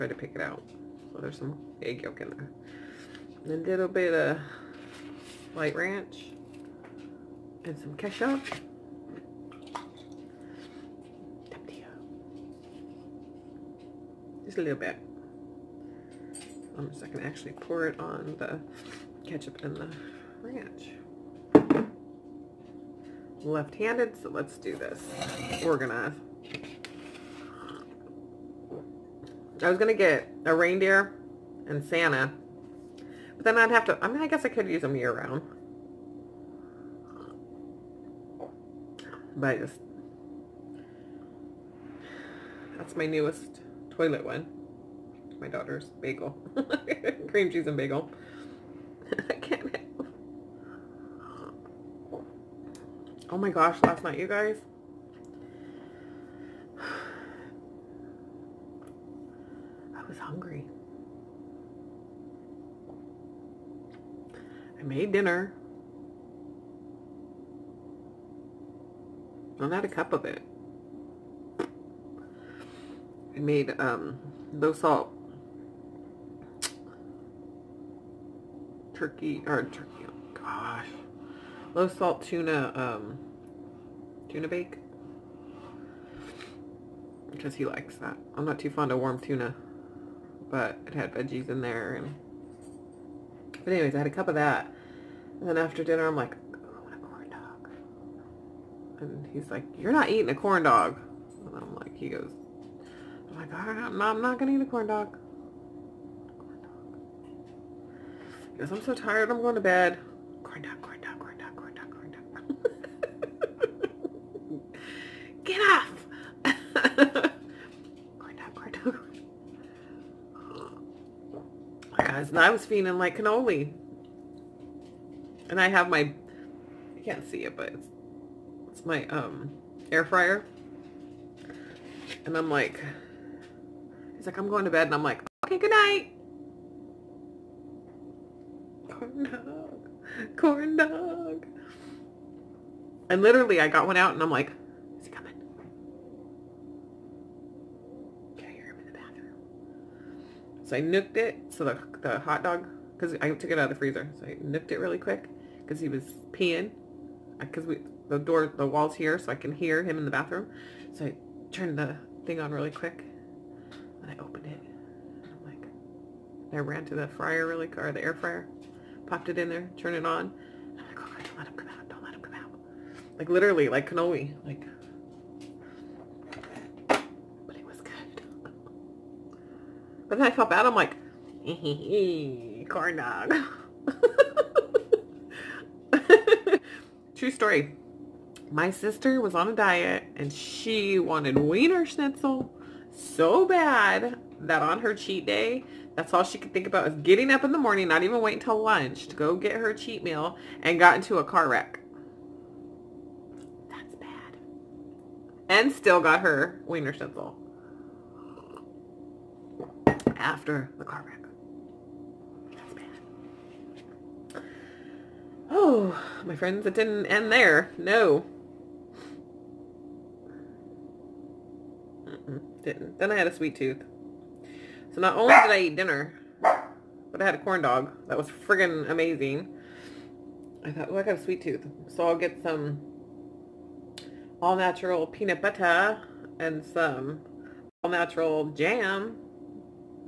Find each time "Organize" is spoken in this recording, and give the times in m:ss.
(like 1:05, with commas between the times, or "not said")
0:25.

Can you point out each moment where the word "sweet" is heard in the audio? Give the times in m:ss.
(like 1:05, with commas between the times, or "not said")
3:43, 3:51.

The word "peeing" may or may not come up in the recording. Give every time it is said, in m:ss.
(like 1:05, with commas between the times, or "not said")
2:36.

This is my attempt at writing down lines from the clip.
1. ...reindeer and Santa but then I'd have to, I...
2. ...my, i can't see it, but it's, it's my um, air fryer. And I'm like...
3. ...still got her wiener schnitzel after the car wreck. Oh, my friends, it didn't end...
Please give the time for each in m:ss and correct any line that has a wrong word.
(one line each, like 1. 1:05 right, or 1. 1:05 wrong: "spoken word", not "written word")
1. 0:30 right
2. 2:05 right
3. 3:25 right.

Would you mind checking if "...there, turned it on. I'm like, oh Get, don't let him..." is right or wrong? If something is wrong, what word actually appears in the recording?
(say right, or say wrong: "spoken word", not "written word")
wrong: "God", not "Get".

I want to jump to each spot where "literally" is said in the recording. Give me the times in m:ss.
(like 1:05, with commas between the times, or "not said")
2:23, 2:53.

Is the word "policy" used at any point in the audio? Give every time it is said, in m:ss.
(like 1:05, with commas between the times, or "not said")
not said.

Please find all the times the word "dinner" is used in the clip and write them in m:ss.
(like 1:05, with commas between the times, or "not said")
1:05, 1:35, 3:45.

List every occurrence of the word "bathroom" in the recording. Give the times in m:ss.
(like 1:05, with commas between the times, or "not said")
2:28, 2:40.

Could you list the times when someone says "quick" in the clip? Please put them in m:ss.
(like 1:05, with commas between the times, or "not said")
2:34, 2:42.